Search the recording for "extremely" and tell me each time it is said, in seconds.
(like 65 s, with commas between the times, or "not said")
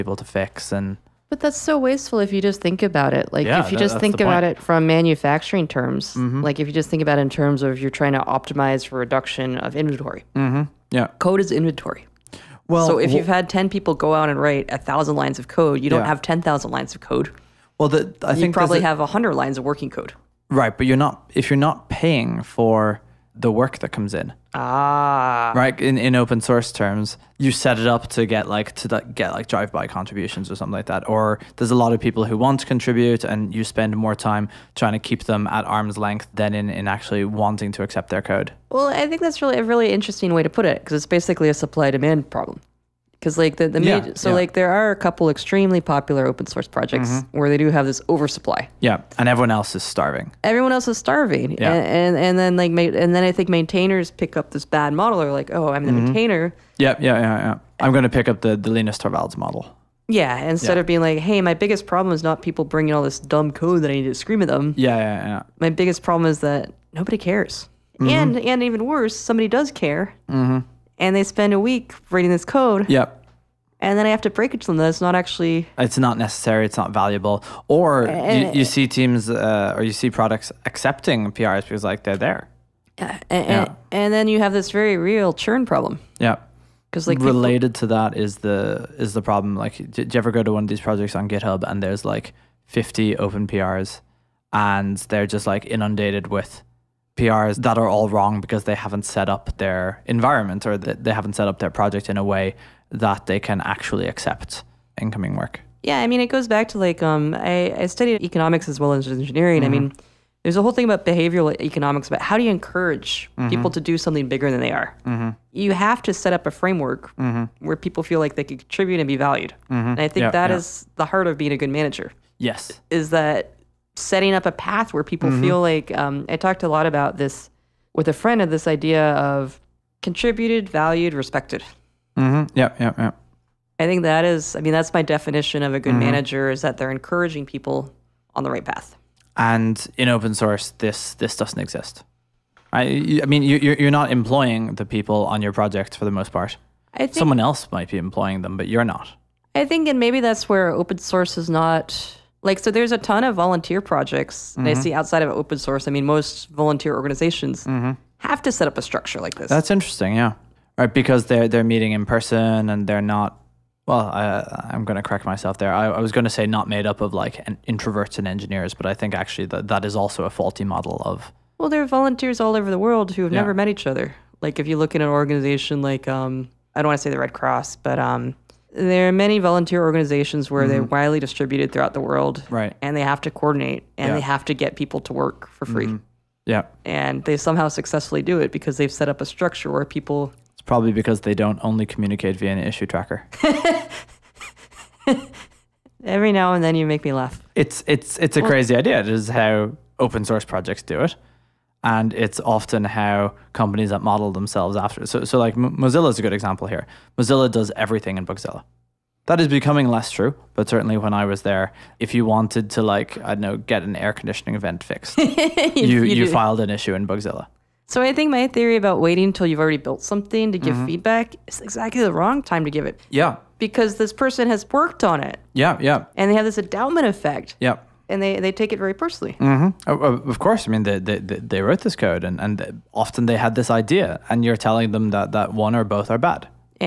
45 s.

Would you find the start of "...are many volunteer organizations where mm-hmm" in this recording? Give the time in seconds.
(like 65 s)
179 s.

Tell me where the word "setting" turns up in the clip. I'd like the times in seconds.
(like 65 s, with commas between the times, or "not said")
123 s.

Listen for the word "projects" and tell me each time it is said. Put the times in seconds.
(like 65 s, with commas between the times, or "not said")
46 s, 90 s, 101 s, 145 s, 153 s, 200 s.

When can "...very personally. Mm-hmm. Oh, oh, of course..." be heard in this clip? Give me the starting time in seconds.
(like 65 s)
228 s.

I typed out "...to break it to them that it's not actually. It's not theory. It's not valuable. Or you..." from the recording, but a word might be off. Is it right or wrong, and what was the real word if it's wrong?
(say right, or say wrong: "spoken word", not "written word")
wrong: "necessary", not "theory".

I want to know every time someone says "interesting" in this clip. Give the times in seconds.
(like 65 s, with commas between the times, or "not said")
39 s, 159 s.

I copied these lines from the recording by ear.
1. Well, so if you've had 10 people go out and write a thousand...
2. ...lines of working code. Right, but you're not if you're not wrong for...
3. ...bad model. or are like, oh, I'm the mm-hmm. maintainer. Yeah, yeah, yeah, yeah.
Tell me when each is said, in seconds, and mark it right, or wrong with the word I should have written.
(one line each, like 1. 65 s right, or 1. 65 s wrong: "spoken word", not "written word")
1. 12 s right
2. 19 s wrong: "paying", not "wrong"
3. 54 s right.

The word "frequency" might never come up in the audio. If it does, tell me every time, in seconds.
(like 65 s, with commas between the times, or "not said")
not said.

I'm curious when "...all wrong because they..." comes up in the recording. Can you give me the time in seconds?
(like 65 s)
97 s.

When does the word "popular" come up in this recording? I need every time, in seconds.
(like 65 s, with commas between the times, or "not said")
45 s.